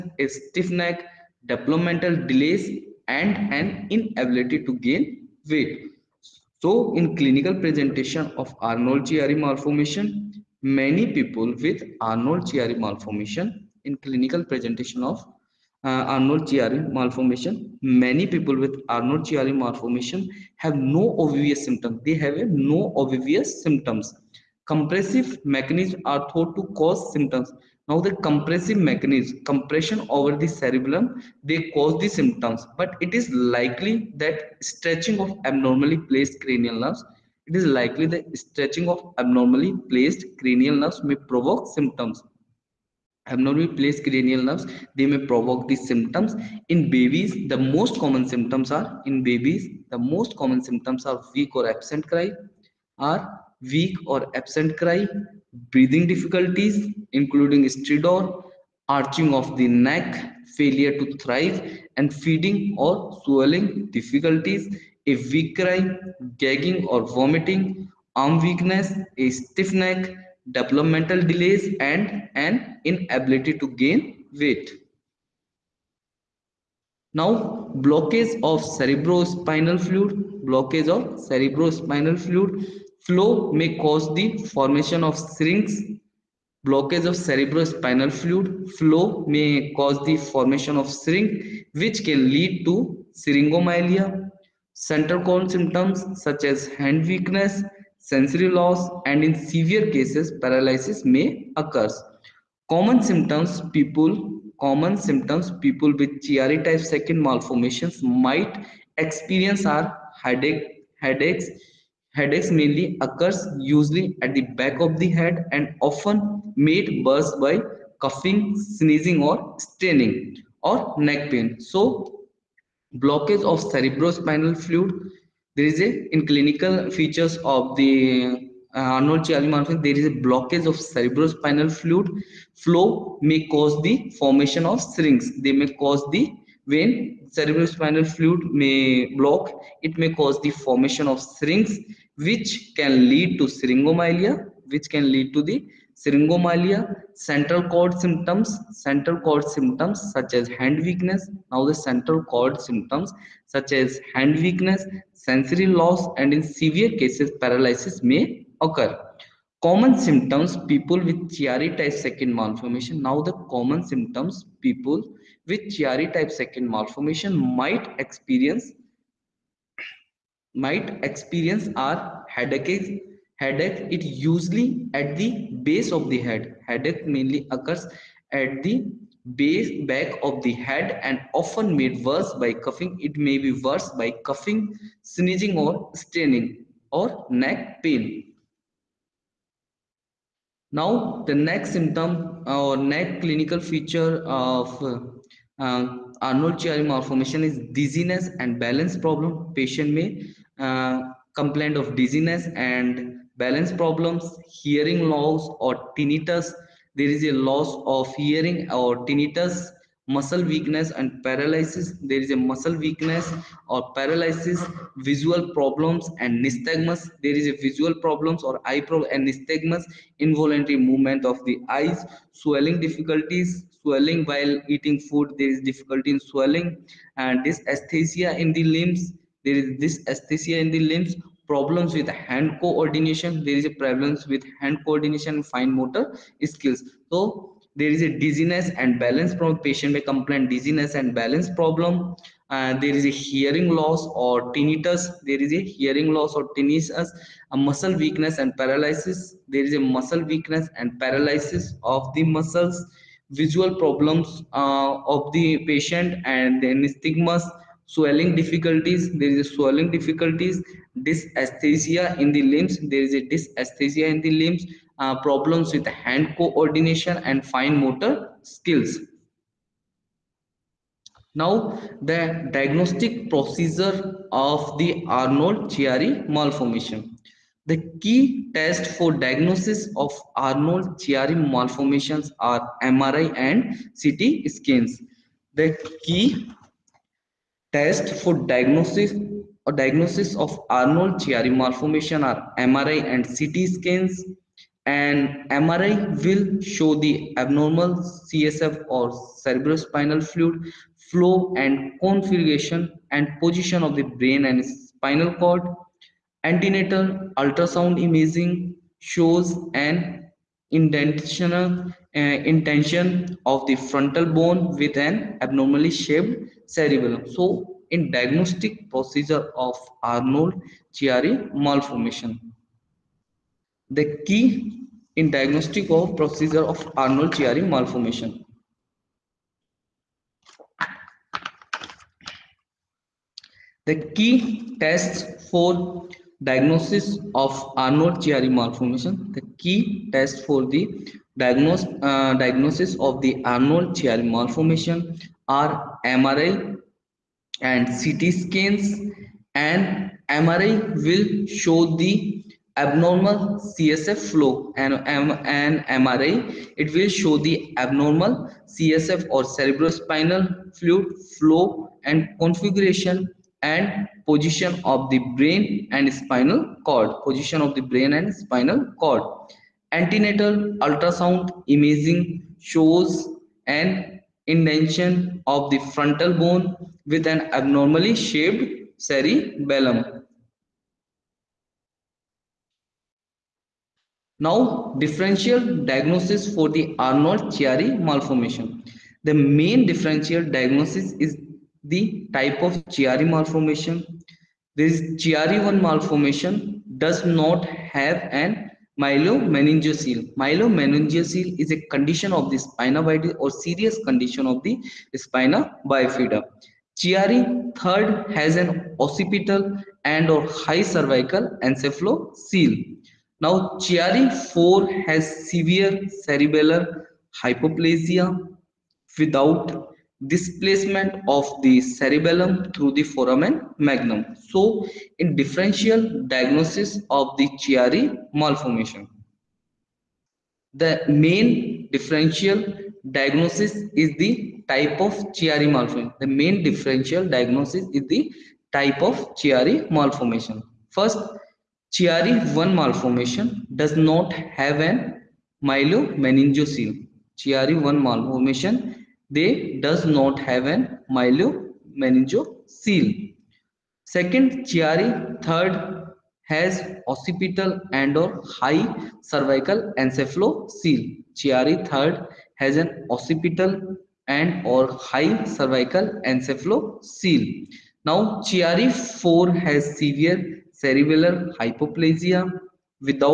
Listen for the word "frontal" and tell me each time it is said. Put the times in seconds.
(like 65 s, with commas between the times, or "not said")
313 s, 375 s.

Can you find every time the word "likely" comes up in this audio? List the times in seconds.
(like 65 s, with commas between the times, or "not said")
33 s, 37 s.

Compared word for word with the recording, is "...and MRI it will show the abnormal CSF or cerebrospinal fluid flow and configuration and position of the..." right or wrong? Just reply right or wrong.
right.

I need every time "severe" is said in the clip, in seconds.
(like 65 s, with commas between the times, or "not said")
99 s, 156 s, 415 s, 469 s.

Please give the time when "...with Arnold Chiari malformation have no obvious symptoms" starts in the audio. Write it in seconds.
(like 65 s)
18 s.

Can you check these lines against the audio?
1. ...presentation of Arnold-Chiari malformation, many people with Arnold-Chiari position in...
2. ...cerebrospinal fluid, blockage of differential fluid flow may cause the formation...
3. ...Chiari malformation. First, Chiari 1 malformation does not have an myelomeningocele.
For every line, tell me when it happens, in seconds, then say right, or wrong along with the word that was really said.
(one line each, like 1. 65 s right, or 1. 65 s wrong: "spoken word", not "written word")
1. 7 s wrong: "malformation", not "position"
2. 78 s wrong: "cerebrospinal", not "differential"
3. 439 s right.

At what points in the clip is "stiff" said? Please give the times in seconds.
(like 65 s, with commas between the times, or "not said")
0 s, 69 s.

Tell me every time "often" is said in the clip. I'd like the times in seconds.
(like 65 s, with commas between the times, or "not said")
115 s, 181 s.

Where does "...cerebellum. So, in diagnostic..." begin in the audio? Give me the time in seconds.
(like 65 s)
316 s.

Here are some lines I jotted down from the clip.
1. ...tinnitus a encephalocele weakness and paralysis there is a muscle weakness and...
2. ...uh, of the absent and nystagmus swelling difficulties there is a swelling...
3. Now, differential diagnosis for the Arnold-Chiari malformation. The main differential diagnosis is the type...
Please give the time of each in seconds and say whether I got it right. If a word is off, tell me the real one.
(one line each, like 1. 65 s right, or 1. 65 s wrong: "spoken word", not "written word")
1. 246 s wrong: "muscle", not "encephalocele"
2. 254 s wrong: "patient", not "absent"
3. 384 s right.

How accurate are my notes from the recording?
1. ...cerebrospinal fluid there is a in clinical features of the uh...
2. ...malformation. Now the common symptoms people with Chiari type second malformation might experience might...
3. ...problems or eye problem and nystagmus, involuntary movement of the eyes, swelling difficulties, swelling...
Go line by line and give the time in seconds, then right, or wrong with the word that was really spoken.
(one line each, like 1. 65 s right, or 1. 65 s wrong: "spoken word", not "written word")
1. 123 s right
2. 162 s right
3. 217 s right.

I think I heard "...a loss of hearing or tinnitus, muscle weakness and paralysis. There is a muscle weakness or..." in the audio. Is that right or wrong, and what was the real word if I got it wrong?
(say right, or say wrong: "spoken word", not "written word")
right.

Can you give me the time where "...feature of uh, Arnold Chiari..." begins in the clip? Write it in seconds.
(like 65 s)
193 s.